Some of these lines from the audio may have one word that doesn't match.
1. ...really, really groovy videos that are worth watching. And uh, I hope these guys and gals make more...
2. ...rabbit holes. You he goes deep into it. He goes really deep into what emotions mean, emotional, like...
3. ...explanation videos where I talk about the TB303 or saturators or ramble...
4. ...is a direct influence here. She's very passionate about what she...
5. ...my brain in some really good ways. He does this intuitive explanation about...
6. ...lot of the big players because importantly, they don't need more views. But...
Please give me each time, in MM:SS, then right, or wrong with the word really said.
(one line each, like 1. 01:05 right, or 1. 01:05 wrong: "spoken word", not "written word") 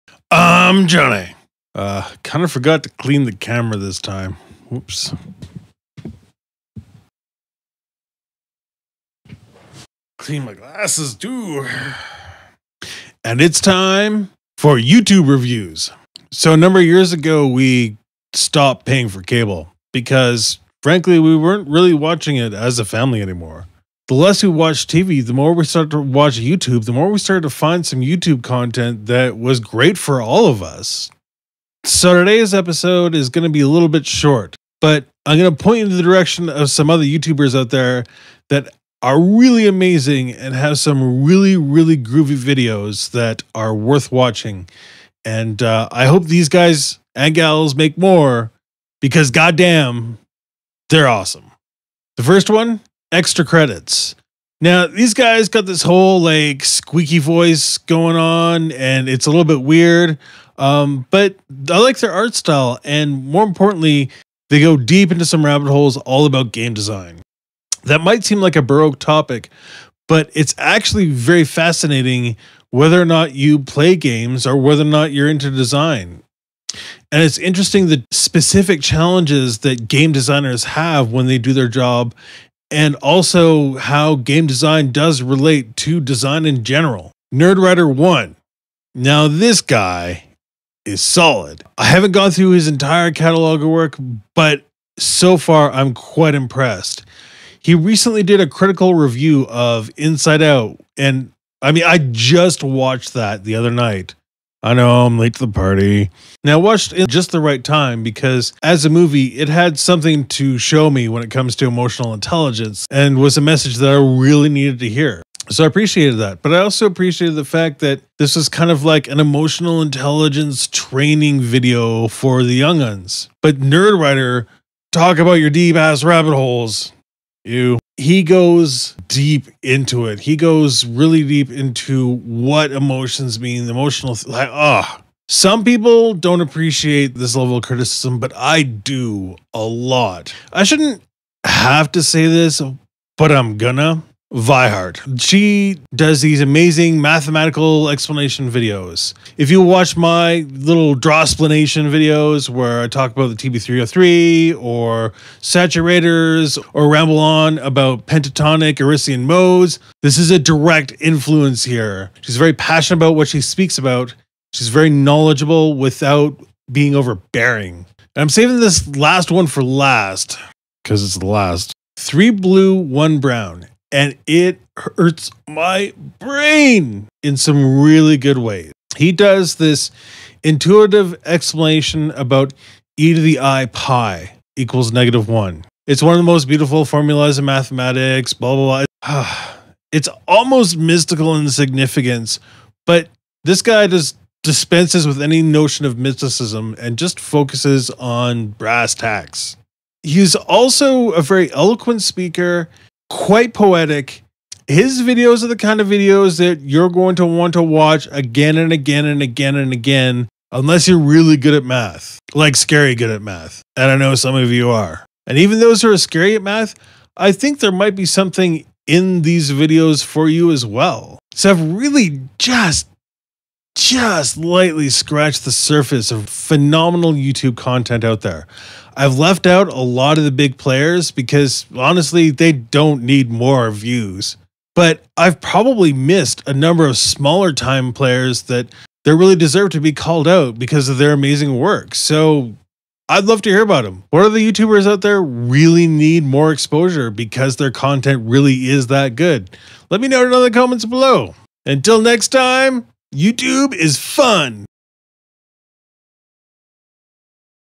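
1. 00:41 right
2. 02:06 right
3. 02:31 right
4. 02:40 right
5. 02:55 right
6. 03:49 wrong: "honestly", not "importantly".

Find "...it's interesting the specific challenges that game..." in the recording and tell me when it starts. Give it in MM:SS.
01:17.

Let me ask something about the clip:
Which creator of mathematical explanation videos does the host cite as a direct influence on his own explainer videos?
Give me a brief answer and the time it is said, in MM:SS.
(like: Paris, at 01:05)
Vihart, at 02:24.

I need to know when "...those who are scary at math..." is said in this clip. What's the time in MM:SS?
03:35.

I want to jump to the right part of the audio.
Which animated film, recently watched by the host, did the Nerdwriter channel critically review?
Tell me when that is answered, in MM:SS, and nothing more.
01:39.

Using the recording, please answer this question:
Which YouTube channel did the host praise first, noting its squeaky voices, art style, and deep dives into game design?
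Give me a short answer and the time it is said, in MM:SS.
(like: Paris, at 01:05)
Extra Credits, at 00:53.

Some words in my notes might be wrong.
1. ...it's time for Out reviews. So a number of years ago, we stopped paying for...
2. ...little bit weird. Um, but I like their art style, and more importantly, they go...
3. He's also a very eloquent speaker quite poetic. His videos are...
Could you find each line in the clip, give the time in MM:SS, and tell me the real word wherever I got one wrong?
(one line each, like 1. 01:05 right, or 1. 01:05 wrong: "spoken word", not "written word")
1. 00:13 wrong: "YouTube", not "Out"
2. 00:59 right
3. 03:20 right.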